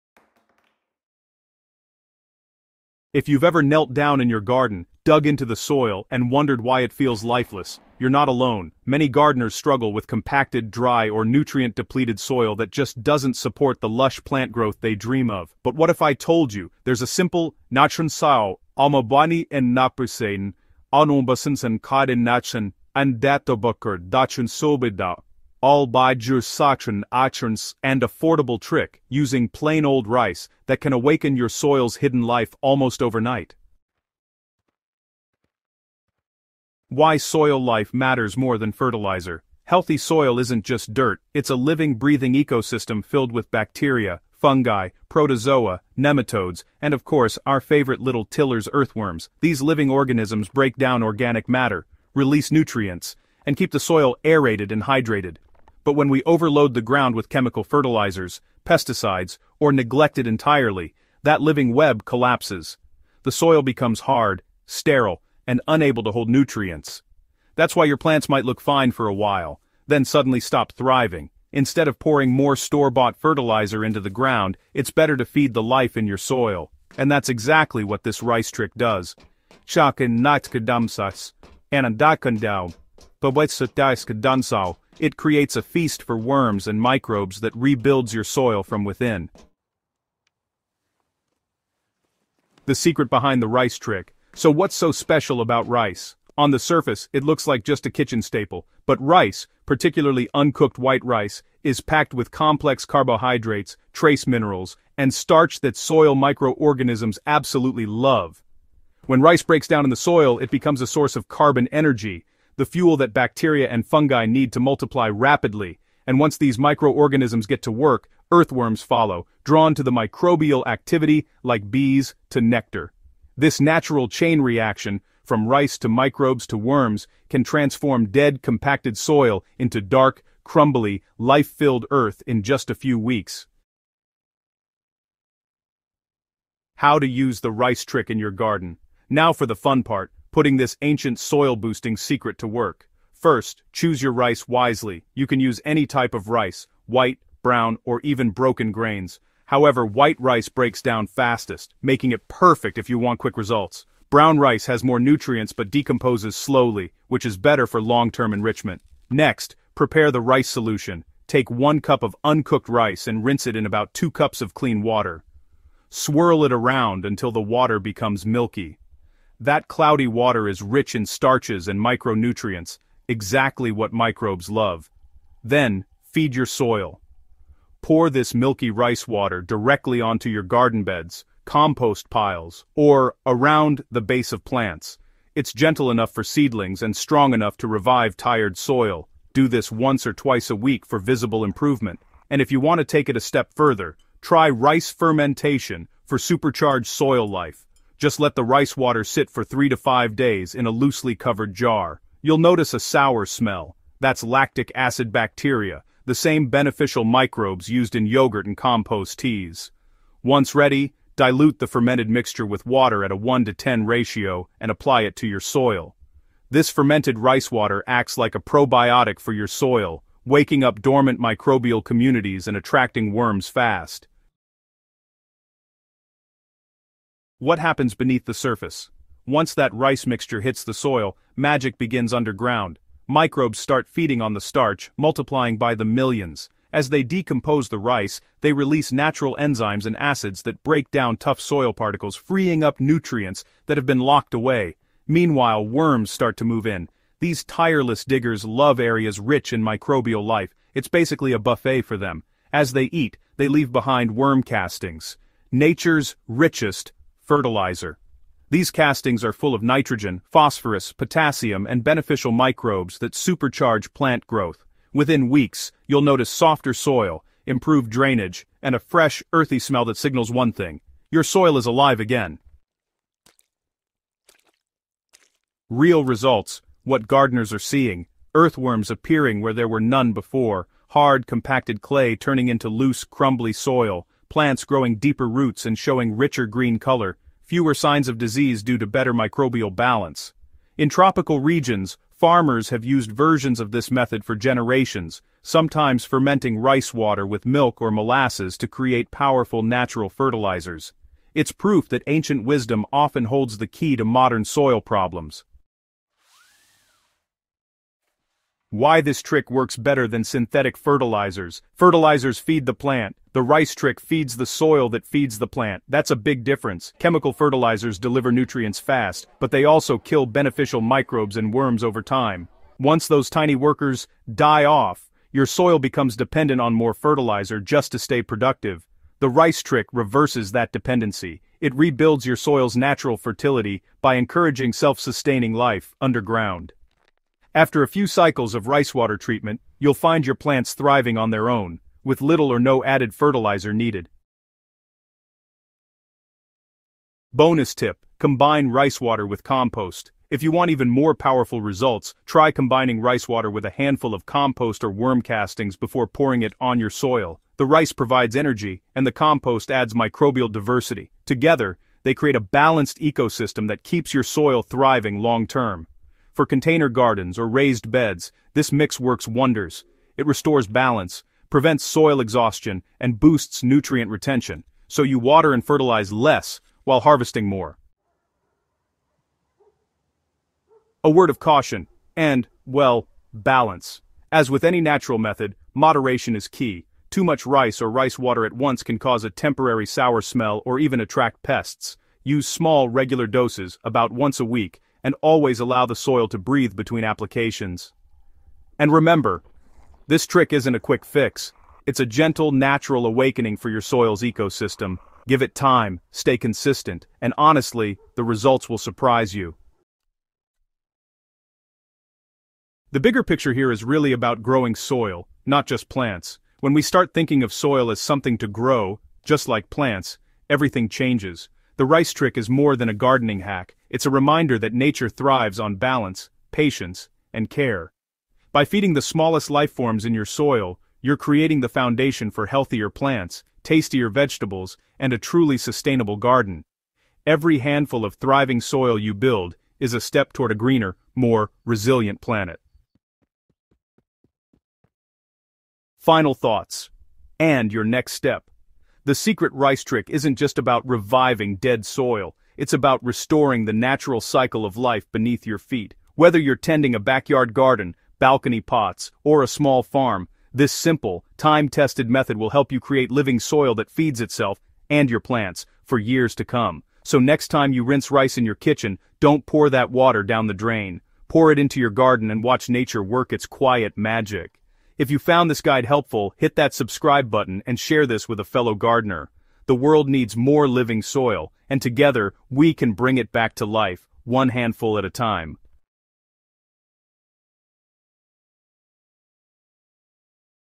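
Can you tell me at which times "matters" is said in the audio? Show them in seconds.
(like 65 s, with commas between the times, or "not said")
37 s, 51 s.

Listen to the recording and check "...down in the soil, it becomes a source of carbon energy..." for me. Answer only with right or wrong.
right.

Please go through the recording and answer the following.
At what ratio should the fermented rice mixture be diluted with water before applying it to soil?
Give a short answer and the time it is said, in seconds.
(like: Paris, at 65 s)
1 to 10, at 213 s.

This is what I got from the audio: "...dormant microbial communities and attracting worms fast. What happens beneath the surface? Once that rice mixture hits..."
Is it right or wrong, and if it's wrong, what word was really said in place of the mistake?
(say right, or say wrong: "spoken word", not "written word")
right.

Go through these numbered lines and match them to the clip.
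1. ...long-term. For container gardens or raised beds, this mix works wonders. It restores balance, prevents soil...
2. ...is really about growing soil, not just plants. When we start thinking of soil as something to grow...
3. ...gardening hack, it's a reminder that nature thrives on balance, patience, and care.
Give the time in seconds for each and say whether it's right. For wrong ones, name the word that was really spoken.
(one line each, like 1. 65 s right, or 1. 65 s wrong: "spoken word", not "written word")
1. 365 s right
2. 413 s right
3. 422 s right.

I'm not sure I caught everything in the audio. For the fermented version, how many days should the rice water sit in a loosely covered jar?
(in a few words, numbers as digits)
3 to 5 days.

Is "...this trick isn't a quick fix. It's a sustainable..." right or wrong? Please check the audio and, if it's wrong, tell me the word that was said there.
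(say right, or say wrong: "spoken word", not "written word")
wrong: "gentle", not "sustainable".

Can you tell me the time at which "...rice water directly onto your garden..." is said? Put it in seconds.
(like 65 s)
178 s.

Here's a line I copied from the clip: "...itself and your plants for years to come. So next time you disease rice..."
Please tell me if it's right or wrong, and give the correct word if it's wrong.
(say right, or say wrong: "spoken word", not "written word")
wrong: "rinse", not "disease".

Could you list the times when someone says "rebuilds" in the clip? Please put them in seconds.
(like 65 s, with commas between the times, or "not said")
87 s, 331 s.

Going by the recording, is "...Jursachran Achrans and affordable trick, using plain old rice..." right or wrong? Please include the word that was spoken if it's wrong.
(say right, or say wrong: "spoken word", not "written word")
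right.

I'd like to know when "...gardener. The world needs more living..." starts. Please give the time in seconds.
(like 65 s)
478 s.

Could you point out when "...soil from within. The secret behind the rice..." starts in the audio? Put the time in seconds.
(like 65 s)
88 s.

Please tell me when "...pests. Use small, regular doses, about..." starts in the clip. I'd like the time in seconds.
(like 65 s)
391 s.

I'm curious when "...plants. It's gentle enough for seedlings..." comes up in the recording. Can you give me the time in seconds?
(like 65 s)
184 s.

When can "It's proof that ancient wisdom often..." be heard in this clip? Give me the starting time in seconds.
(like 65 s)
301 s.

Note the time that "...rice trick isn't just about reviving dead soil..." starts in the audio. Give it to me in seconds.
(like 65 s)
449 s.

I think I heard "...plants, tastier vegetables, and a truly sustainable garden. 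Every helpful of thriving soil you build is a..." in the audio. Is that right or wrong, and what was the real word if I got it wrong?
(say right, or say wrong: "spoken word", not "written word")
wrong: "handful", not "helpful".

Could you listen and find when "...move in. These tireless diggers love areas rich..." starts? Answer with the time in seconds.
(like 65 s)
246 s.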